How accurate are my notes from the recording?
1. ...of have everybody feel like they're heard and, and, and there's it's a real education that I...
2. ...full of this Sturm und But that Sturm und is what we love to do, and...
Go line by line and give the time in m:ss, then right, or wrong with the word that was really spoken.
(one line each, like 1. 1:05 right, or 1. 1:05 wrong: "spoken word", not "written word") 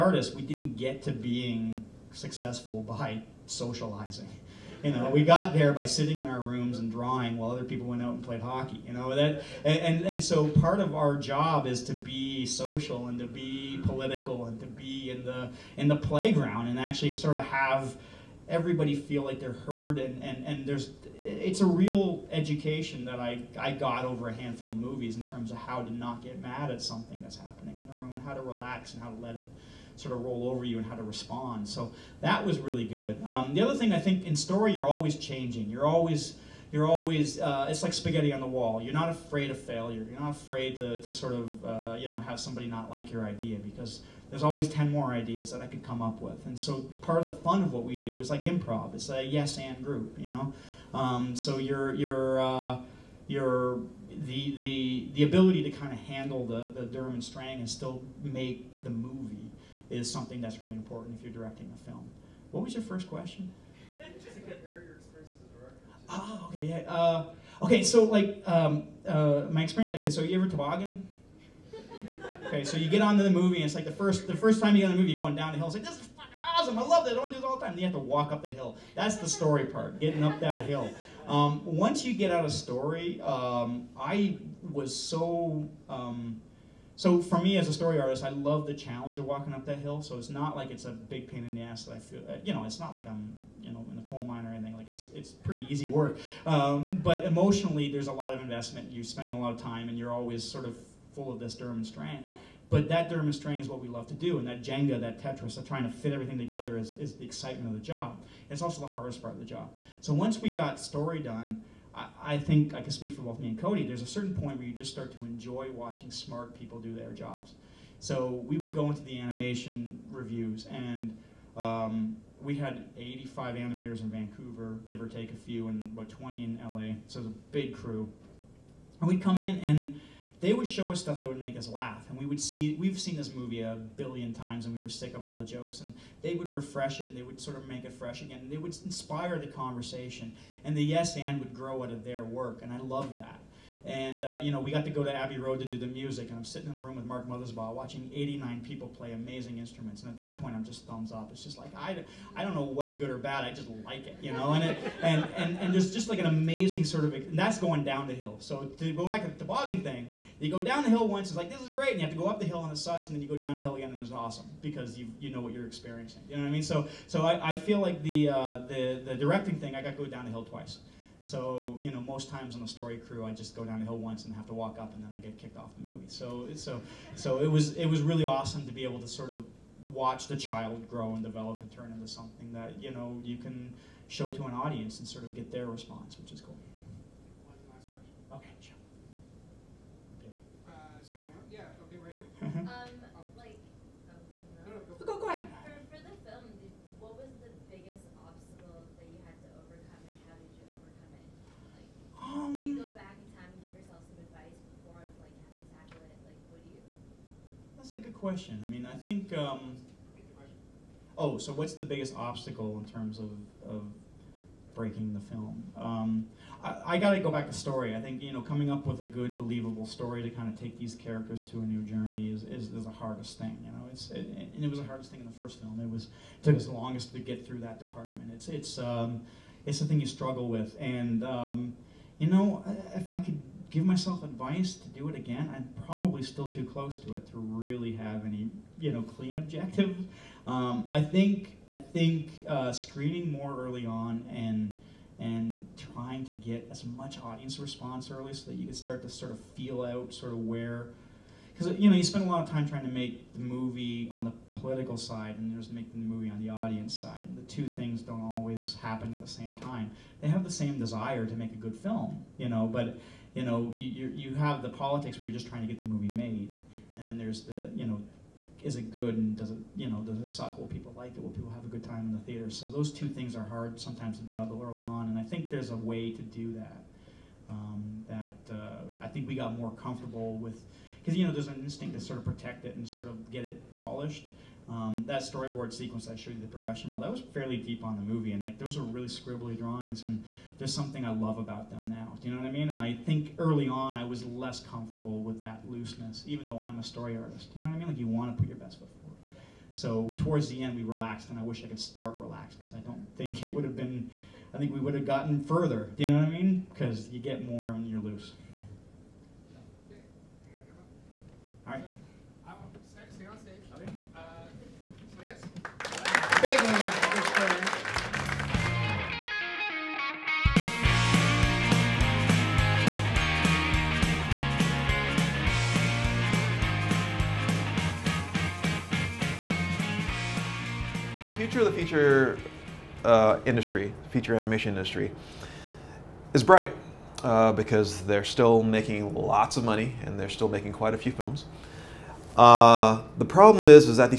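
1. 0:17 right
2. 1:41 right.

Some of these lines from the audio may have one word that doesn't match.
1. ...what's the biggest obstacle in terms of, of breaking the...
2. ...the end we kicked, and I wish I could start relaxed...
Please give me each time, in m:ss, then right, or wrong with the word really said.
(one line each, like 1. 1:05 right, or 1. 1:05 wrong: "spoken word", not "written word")
1. 3:31 right
2. 5:00 wrong: "relaxed", not "kicked".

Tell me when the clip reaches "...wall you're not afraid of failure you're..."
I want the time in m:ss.
0:38.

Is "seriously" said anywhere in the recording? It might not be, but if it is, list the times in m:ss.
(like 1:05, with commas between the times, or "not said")
not said.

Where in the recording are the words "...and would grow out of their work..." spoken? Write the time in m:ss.
2:21.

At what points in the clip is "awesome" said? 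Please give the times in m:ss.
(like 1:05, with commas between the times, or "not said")
1:16, 2:44, 2:58.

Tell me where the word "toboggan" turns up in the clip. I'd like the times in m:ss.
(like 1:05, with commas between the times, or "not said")
1:10, 2:39.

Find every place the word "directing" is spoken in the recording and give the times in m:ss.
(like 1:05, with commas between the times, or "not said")
1:01, 2:49.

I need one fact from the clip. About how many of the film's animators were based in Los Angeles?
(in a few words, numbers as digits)
20.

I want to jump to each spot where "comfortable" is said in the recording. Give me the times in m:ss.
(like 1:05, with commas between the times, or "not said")
4:39, 4:54.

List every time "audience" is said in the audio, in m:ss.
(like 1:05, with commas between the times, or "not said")
3:04, 4:07, 4:16.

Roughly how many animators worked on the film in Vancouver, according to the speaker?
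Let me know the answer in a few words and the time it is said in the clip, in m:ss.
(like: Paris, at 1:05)
85, at 2:02.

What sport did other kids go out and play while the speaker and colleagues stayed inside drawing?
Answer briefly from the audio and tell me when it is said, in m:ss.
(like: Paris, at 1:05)
hockey, at 0:08.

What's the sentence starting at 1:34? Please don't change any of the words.
Like it's it's pretty easy work.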